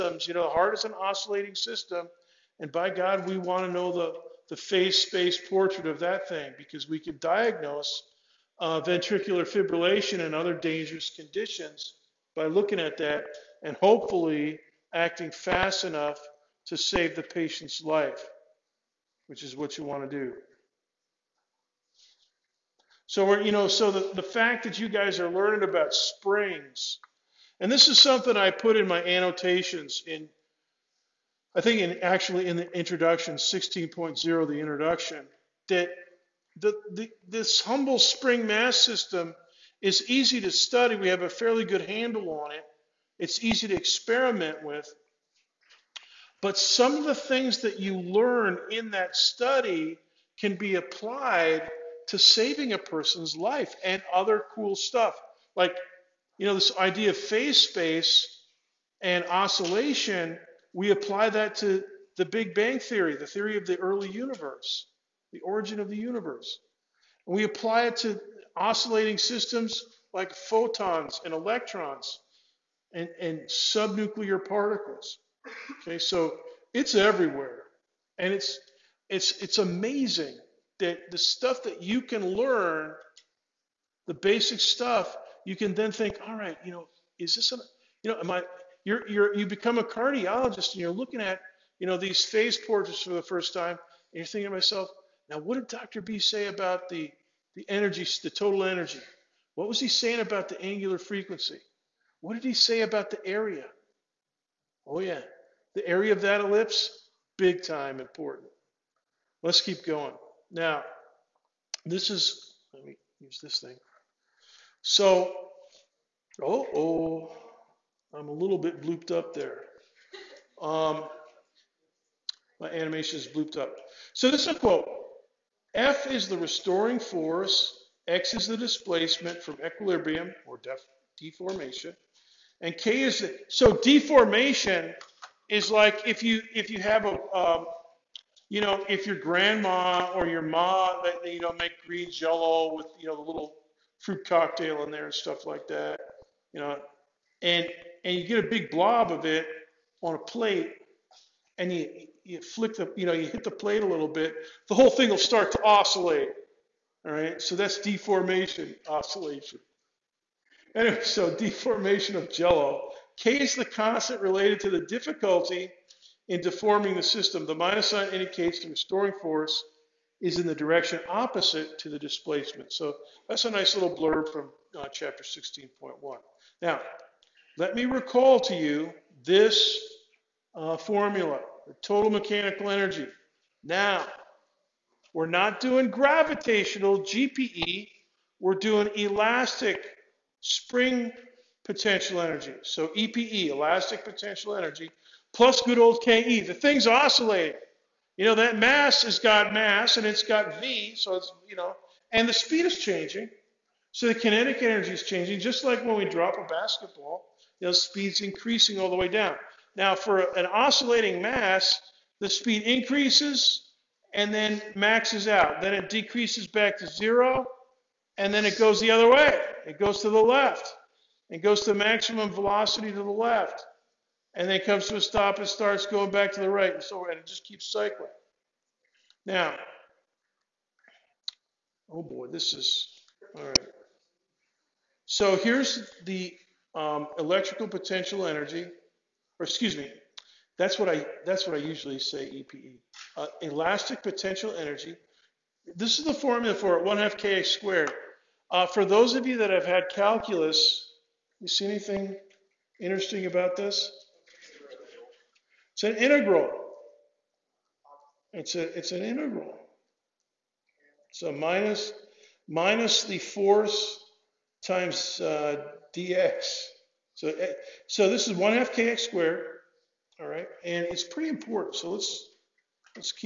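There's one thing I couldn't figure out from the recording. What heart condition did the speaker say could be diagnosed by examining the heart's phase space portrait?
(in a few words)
ventricular fibrillation.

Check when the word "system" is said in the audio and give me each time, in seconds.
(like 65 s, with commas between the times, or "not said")
1 s, 38 s, 69 s, 167 s.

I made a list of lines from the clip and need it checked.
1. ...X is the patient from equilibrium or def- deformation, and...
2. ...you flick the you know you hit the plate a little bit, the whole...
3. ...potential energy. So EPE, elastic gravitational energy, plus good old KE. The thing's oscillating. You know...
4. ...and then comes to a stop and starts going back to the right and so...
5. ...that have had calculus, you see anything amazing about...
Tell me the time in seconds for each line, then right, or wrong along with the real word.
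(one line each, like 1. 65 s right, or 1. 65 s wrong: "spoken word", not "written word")
1. 128 s wrong: "displacement", not "patient"
2. 152 s right
3. 191 s wrong: "potential", not "gravitational"
4. 224 s right
5. 249 s wrong: "interesting", not "amazing".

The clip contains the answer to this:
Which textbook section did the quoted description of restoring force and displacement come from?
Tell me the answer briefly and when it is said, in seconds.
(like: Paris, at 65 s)
Chapter 16.1, at 174 s.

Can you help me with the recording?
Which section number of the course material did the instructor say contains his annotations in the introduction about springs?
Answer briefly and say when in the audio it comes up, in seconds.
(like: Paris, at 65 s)
16.0, at 33 s.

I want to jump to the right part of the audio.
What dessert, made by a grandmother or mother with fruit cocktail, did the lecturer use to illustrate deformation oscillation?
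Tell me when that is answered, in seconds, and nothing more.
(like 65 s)
141 s.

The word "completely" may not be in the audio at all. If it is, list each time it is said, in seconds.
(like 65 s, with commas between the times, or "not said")
not said.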